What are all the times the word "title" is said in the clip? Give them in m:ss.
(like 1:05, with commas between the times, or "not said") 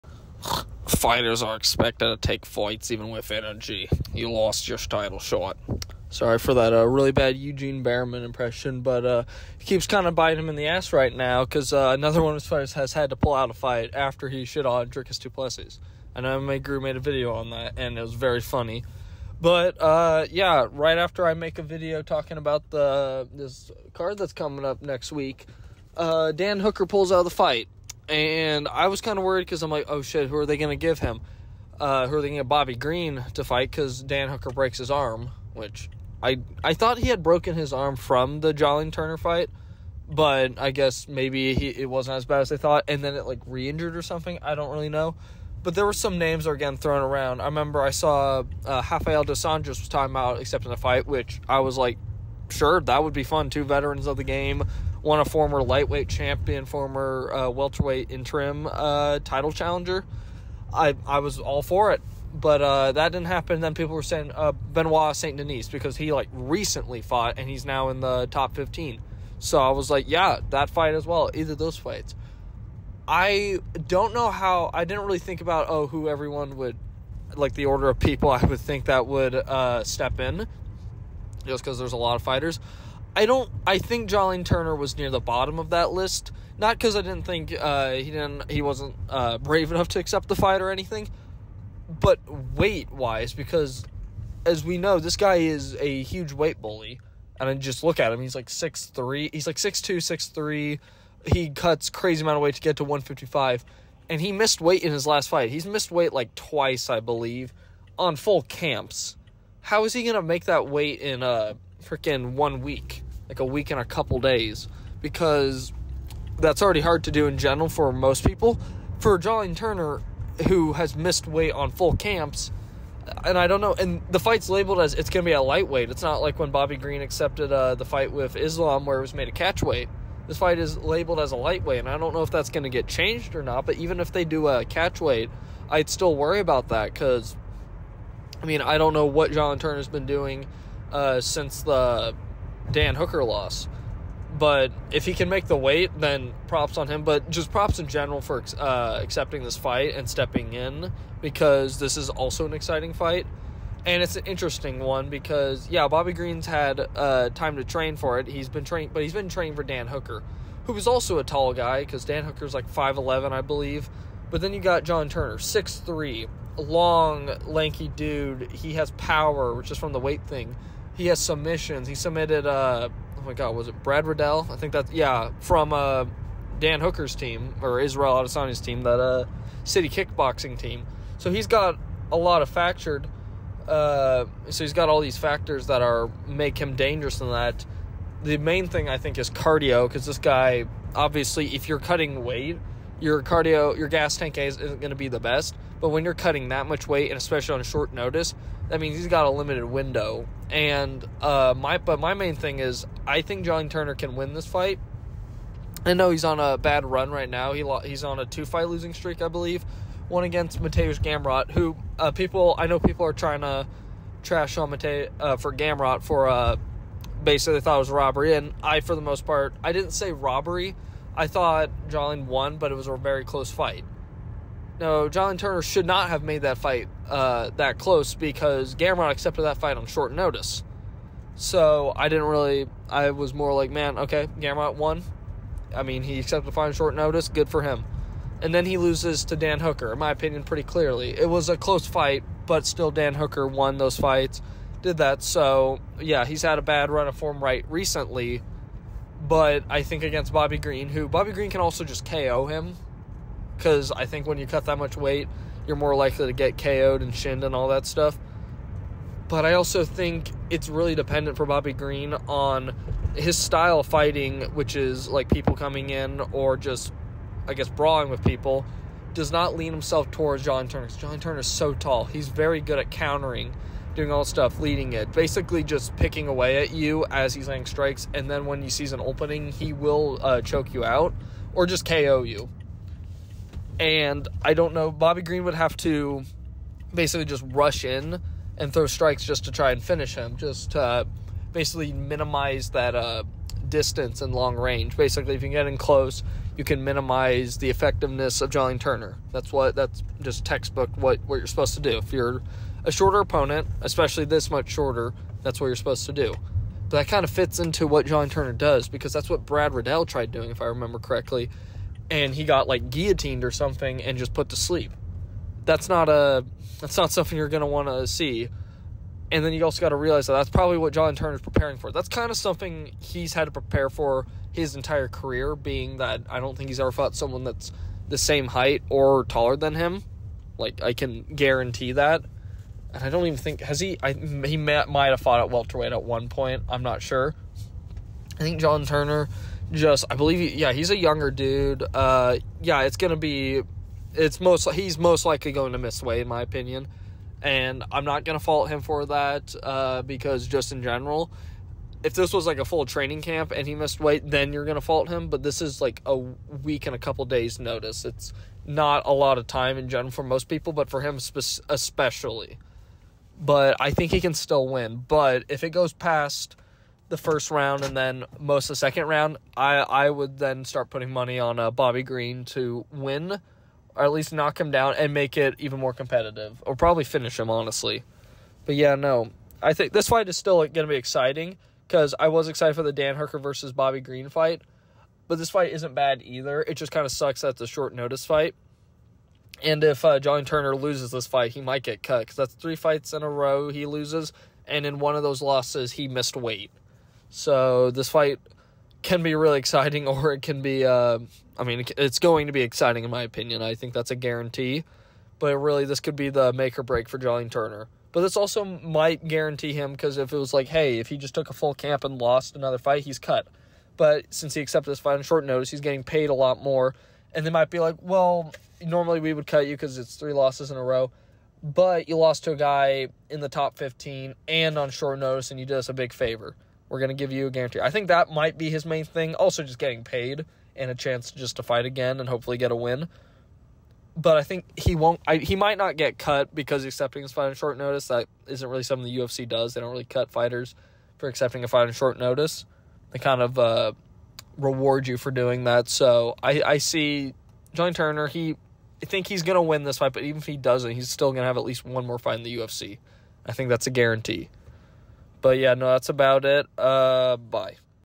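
0:04, 0:59.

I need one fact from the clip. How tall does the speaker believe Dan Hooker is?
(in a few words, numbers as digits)
5'11.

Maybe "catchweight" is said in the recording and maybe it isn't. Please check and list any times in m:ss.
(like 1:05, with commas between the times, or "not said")
2:09, 2:14.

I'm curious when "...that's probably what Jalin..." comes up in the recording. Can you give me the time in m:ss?
5:20.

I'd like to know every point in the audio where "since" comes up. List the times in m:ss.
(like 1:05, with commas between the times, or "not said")
2:21, 6:54.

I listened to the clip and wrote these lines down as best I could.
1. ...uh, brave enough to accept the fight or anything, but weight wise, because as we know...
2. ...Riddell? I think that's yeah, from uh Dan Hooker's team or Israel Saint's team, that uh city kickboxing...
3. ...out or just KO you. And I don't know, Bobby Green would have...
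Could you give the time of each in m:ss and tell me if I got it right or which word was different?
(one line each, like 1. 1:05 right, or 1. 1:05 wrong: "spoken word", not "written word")
1. 1:29 right
2. 2:54 wrong: "Adesanya", not "Saint"
3. 4:40 right.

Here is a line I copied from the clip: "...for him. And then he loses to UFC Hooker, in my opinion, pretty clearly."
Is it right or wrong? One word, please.
wrong.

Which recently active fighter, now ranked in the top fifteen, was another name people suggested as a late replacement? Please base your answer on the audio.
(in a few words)
Benoit Saint Denis.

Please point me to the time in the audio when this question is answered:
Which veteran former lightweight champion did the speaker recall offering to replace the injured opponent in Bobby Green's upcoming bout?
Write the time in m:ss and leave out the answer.
0:48.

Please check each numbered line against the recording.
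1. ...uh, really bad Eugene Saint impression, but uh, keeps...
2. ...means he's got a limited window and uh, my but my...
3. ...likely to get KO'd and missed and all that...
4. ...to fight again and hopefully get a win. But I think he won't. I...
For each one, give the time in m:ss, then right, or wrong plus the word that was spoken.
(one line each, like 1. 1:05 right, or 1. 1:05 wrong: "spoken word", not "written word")
1. 0:06 wrong: "Bareman", not "Saint"
2. 3:18 right
3. 4:15 wrong: "shinned", not "missed"
4. 7:11 right.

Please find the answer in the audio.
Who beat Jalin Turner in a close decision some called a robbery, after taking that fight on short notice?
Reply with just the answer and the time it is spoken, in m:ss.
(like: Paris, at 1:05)
Mateusz Gamrot, at 3:30.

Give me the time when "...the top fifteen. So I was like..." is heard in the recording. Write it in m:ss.
1:07.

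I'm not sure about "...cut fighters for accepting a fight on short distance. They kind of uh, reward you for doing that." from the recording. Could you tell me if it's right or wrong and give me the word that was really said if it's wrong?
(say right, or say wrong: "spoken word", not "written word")
wrong: "notice", not "distance".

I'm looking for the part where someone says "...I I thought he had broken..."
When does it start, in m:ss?
0:36.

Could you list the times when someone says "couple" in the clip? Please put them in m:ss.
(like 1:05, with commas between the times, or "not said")
1:53, 5:56.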